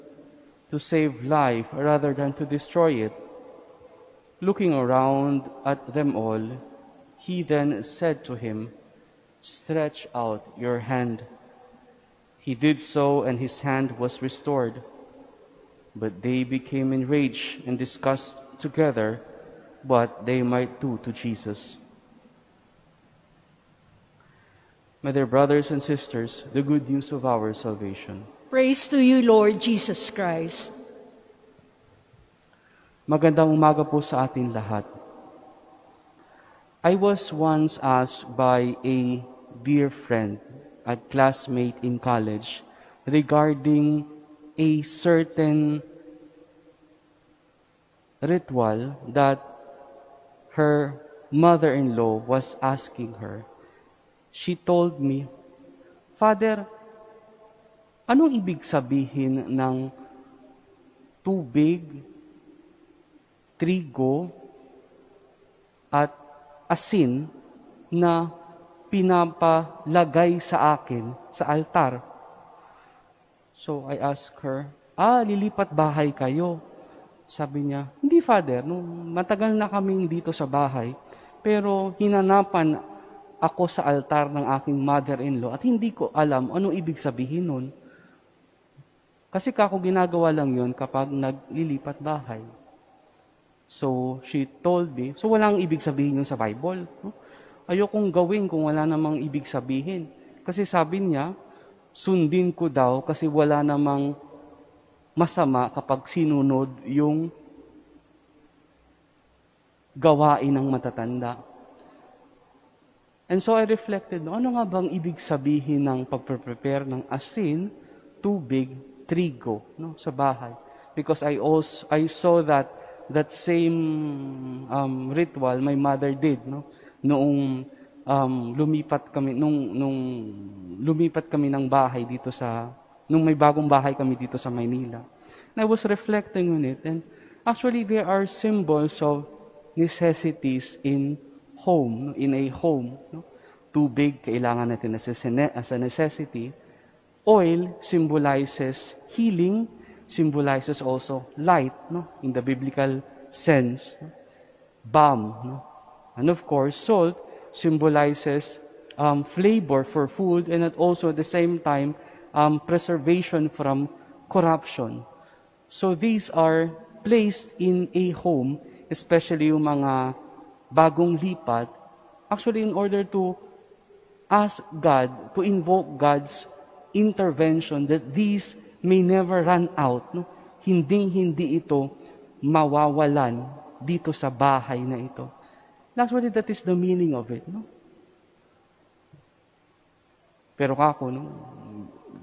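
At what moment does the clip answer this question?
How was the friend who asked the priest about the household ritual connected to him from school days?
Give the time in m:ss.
0:41.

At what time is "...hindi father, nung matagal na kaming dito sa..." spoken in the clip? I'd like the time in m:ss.
1:18.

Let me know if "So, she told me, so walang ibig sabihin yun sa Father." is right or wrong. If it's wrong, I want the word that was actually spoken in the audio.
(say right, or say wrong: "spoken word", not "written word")
wrong: "Bible", not "Father".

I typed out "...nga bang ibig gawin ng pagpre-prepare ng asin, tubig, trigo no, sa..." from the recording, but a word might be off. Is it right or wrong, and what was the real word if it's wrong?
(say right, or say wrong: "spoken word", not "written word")
wrong: "sabihin", not "gawin".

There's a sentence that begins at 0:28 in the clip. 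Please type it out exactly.
Praise to you, Lord Jesus Christ.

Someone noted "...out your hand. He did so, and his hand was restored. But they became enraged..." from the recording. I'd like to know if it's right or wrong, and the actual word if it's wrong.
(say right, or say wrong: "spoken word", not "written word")
right.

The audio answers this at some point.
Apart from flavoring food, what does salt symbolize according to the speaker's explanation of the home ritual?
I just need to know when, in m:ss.
2:42.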